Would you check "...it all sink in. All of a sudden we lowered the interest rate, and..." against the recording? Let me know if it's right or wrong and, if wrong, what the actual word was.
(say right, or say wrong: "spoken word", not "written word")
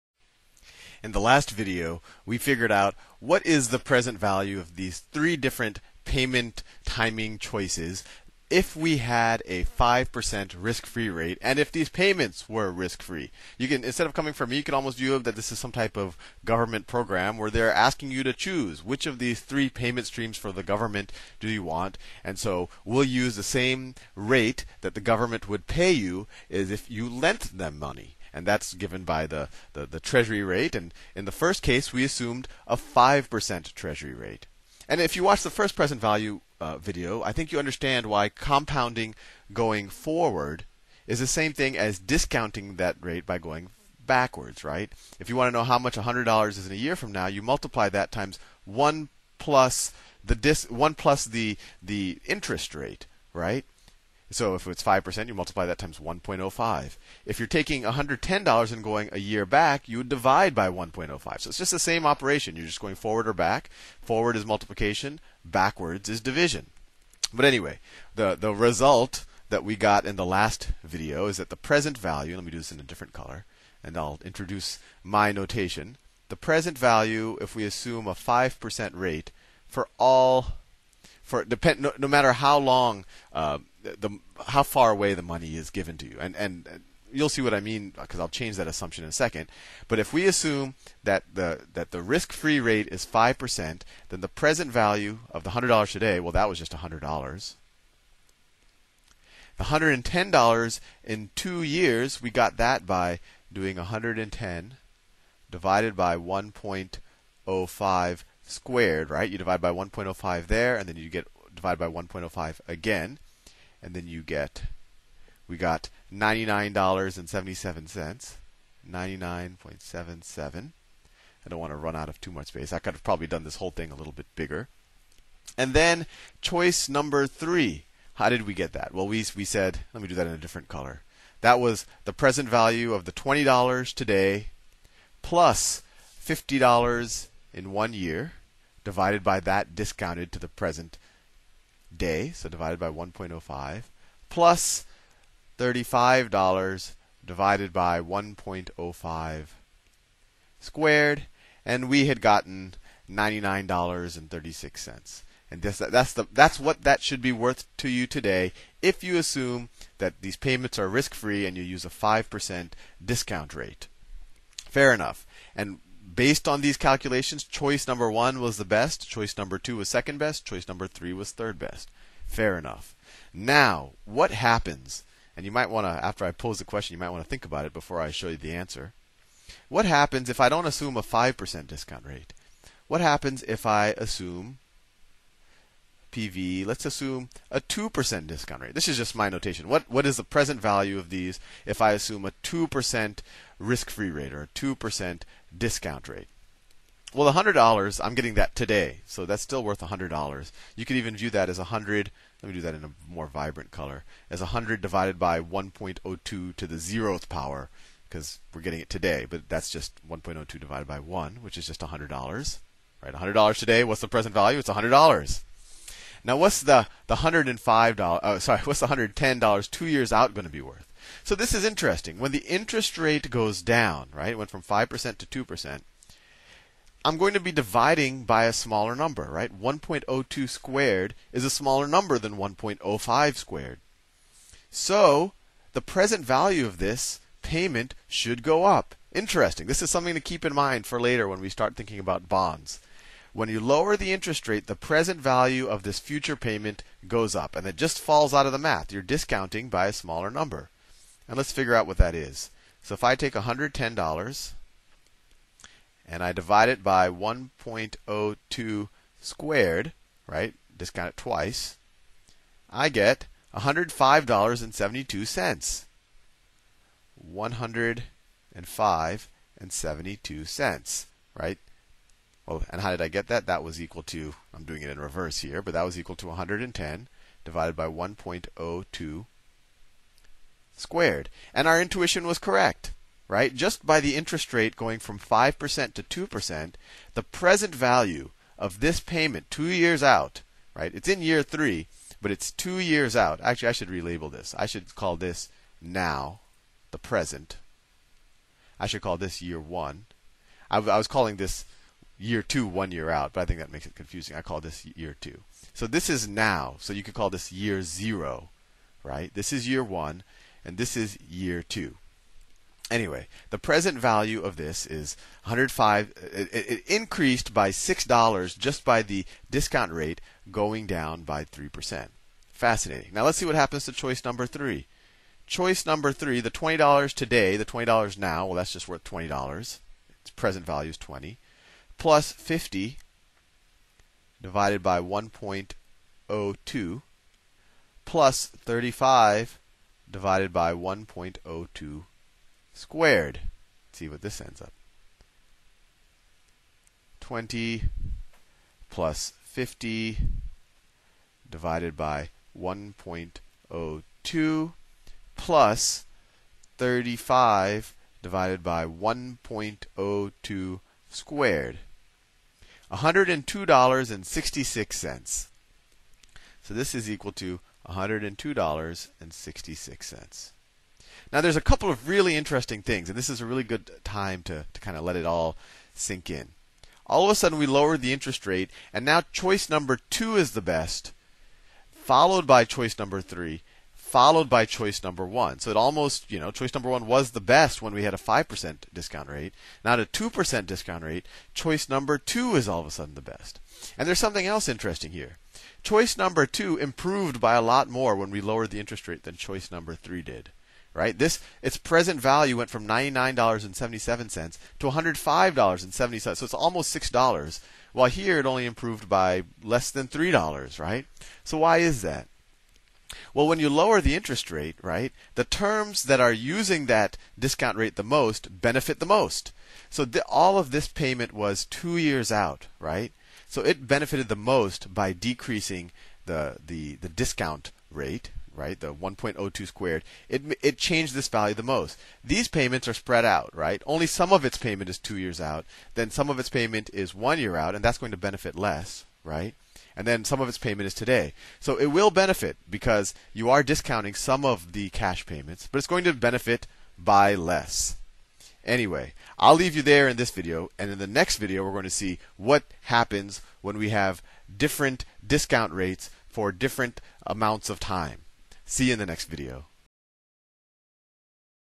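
right.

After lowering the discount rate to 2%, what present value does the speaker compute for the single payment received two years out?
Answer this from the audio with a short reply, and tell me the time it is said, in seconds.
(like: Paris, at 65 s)
$105.72, at 263 s.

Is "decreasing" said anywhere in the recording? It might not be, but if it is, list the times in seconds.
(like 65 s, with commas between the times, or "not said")
425 s.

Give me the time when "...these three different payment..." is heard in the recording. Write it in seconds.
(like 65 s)
4 s.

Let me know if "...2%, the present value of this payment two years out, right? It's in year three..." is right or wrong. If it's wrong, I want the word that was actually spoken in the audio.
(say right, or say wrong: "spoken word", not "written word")
right.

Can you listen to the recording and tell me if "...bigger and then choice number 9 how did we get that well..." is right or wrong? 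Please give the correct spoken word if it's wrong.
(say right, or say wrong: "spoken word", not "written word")
wrong: "3", not "9".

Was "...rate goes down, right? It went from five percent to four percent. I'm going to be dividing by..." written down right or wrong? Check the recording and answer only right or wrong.
wrong.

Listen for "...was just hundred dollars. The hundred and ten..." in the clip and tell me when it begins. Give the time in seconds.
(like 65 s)
96 s.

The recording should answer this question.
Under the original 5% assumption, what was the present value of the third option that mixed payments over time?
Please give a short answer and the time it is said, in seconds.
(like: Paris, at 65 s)
$99.36, at 153 s.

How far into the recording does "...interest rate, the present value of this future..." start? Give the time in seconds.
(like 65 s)
244 s.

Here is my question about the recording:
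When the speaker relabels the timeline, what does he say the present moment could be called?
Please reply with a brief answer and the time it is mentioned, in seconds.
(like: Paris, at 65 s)
year zero, at 307 s.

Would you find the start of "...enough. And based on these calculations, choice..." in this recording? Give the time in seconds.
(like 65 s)
164 s.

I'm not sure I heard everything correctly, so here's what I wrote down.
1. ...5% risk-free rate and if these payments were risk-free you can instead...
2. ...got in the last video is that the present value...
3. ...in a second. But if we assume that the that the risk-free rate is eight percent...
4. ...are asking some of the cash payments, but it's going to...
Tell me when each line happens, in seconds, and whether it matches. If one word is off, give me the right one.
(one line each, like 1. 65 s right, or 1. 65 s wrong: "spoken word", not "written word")
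1. 9 s right
2. 69 s right
3. 89 s wrong: "five", not "eight"
4. 443 s wrong: "discounting", not "asking".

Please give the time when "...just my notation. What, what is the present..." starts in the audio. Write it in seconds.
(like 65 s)
188 s.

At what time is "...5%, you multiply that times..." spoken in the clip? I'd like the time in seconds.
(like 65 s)
54 s.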